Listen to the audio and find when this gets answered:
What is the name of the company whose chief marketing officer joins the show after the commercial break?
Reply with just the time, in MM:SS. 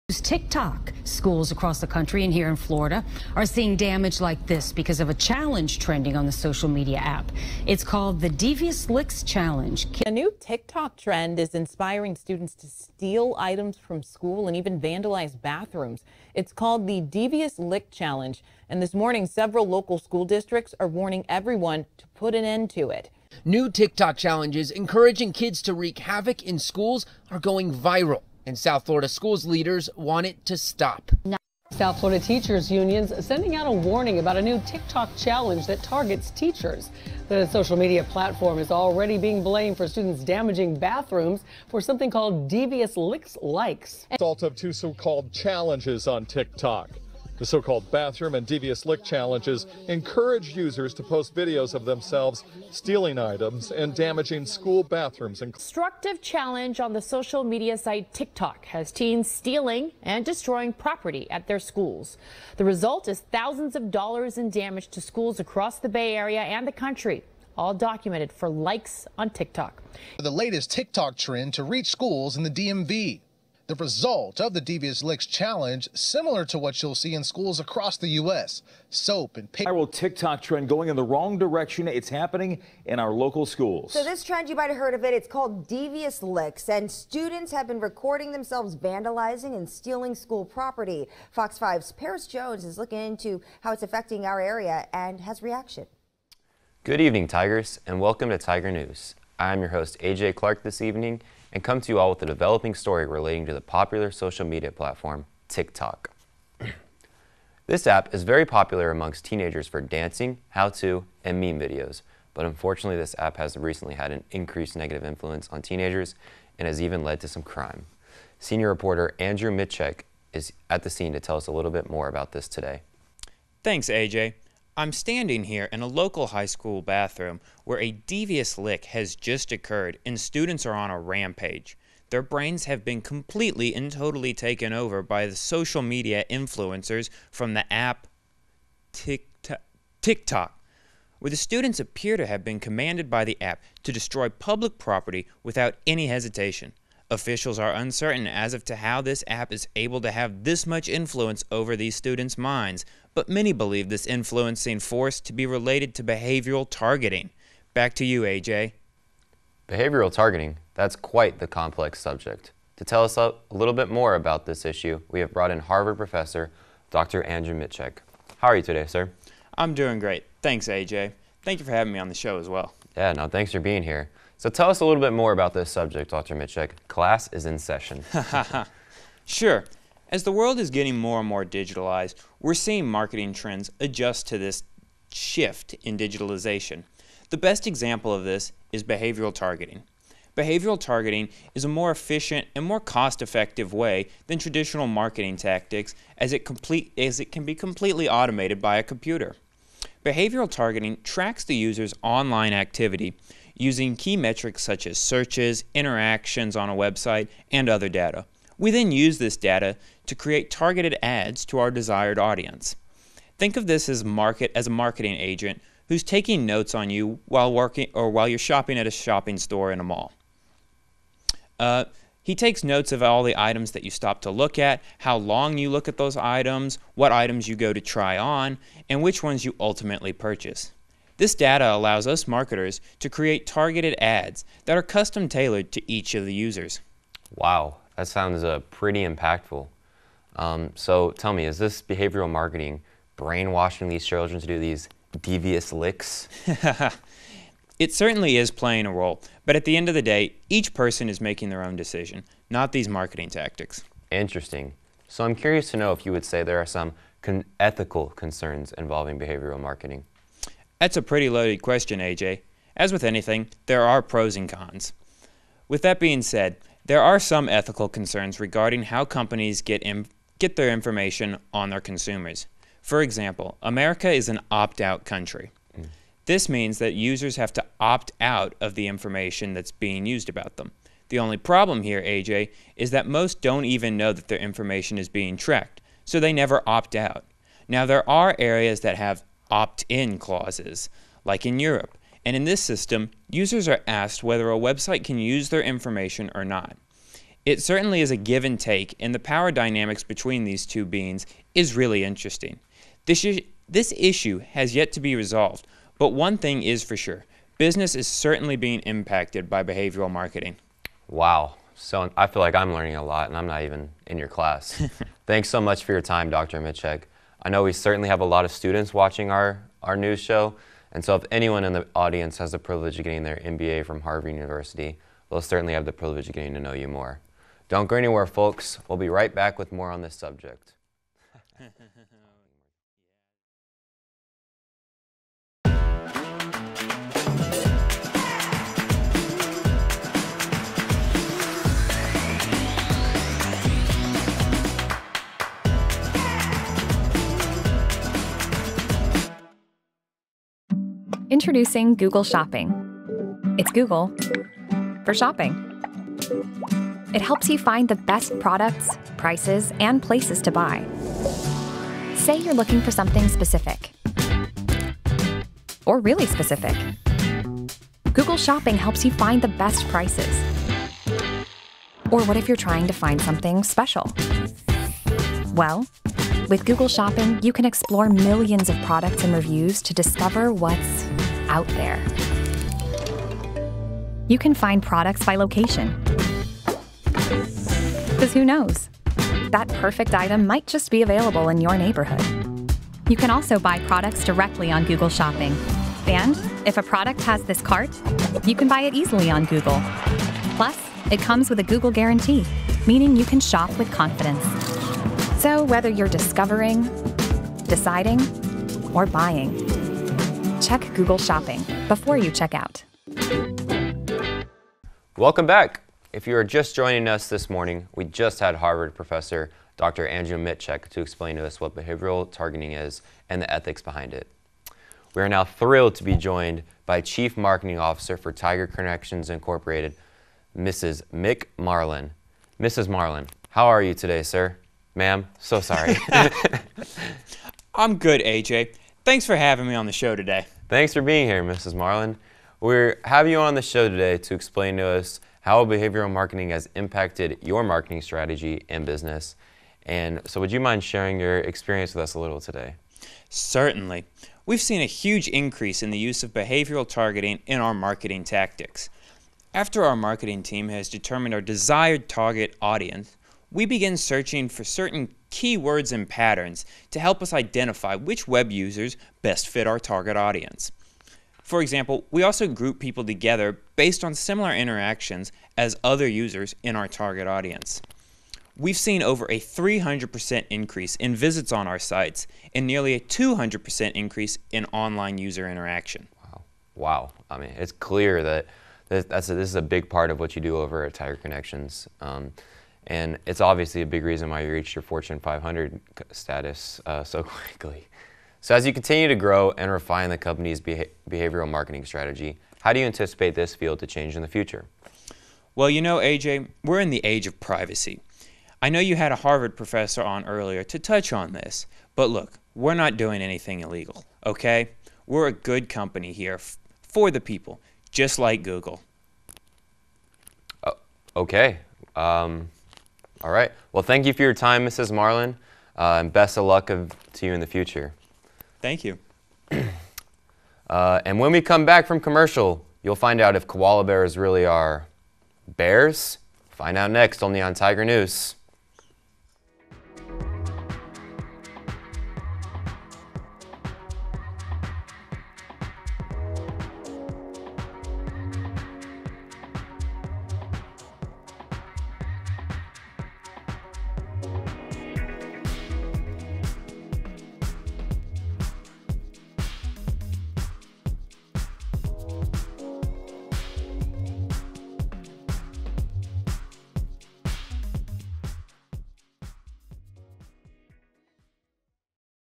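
07:08.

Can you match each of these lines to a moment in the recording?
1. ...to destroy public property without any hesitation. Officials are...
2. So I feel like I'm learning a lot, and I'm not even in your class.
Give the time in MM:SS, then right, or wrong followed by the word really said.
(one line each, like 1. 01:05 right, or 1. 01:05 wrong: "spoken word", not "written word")
1. 02:23 right
2. 05:11 right.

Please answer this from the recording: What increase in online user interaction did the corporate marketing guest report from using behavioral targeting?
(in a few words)
nearly 200%.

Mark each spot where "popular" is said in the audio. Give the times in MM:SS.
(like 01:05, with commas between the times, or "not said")
01:43, 01:48.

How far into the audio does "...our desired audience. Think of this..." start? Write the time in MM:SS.
03:31.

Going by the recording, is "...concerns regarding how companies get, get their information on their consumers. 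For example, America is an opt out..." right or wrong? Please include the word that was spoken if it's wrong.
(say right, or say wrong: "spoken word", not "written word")
right.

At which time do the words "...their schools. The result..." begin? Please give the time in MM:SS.
01:01.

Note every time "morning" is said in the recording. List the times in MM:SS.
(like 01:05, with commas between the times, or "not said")
00:18, 06:57.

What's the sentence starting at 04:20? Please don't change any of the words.
That's a pretty loaded question, AJ.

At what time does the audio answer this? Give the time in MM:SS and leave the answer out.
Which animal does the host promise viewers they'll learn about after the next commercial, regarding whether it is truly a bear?
08:53.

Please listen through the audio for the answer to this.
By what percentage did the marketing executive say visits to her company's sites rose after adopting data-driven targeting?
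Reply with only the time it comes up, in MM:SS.
07:59.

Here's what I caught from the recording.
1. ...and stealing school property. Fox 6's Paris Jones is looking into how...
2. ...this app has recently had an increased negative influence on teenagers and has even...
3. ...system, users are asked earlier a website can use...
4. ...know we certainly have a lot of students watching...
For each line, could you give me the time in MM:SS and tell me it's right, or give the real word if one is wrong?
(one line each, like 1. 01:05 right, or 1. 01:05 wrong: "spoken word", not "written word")
1. 01:29 wrong: "5", not "6"
2. 01:52 right
3. 04:52 wrong: "whether", not "earlier"
4. 05:17 right.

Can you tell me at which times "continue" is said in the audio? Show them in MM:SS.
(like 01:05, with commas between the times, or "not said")
08:18.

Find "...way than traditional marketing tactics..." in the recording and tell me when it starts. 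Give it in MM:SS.
03:13.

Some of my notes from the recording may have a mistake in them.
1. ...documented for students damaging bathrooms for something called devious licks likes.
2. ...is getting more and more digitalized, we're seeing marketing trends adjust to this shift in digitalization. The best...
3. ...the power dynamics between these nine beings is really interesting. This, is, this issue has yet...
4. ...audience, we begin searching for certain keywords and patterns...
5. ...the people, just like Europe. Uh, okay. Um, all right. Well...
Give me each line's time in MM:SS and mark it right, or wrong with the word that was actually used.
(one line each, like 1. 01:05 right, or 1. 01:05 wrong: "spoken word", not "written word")
1. 00:39 wrong: "blamed", not "documented"
2. 03:00 right
3. 04:59 wrong: "two", not "nine"
4. 07:42 right
5. 08:37 wrong: "Google", not "Europe".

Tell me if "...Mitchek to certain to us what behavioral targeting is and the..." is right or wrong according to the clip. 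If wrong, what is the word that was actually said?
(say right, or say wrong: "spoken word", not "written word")
wrong: "explain", not "certain".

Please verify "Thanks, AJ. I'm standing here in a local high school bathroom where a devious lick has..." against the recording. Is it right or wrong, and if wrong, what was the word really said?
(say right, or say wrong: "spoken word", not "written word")
right.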